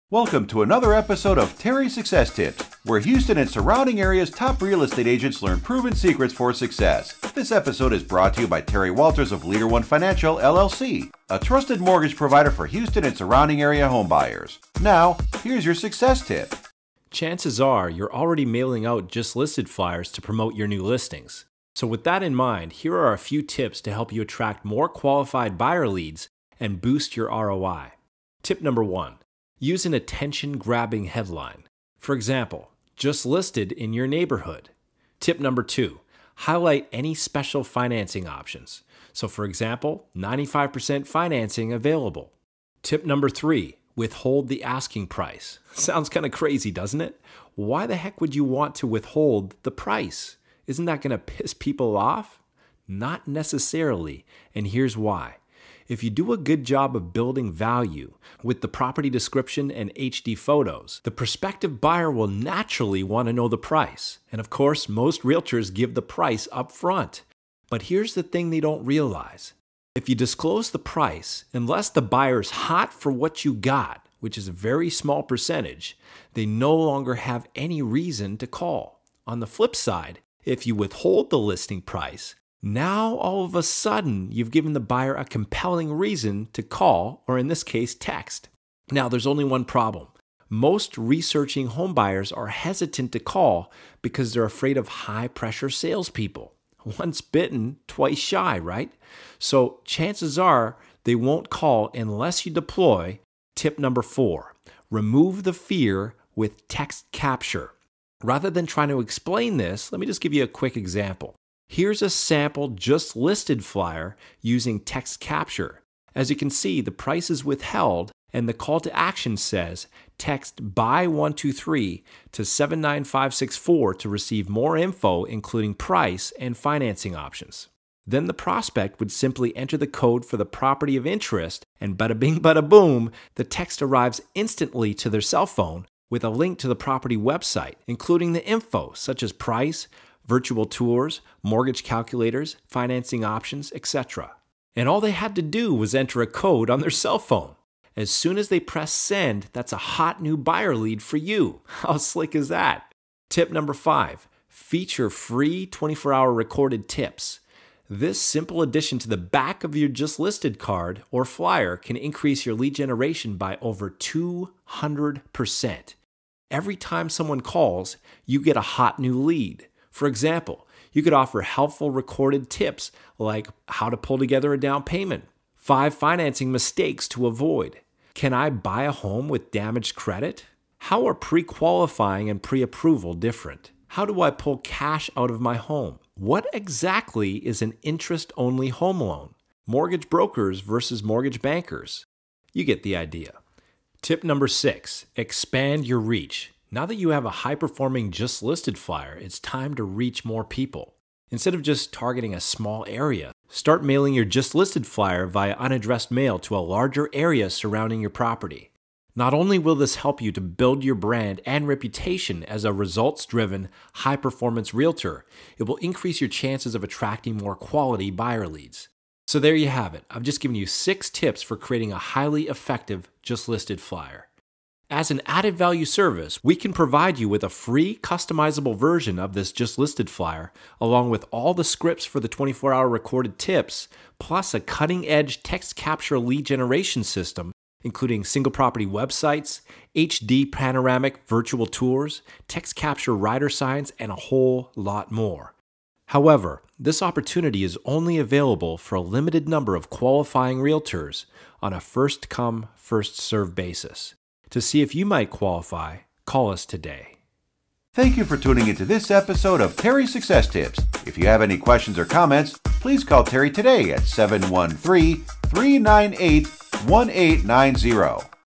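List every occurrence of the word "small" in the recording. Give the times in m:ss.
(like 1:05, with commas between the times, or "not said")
1:14, 3:22.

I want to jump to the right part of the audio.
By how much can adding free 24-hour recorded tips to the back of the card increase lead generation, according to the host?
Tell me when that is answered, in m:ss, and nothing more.
2:43.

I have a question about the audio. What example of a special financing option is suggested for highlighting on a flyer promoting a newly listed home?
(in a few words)
95% financing.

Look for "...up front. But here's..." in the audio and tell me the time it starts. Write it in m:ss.
1:06.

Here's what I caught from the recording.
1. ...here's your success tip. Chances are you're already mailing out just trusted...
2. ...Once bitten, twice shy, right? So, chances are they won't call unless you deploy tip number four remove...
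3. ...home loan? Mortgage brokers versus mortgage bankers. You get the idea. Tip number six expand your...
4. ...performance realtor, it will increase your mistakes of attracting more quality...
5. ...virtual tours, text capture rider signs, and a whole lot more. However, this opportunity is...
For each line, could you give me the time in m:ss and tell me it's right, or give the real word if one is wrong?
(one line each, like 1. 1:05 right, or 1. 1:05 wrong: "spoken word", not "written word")
1. 0:15 wrong: "listed", not "trusted"
2. 1:36 right
3. 3:08 right
4. 3:34 wrong: "chances", not "mistakes"
5. 4:01 right.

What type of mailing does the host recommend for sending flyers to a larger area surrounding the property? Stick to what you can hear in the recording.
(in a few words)
unaddressed mail.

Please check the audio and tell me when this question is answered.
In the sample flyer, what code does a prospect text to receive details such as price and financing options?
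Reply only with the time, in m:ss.
2:00.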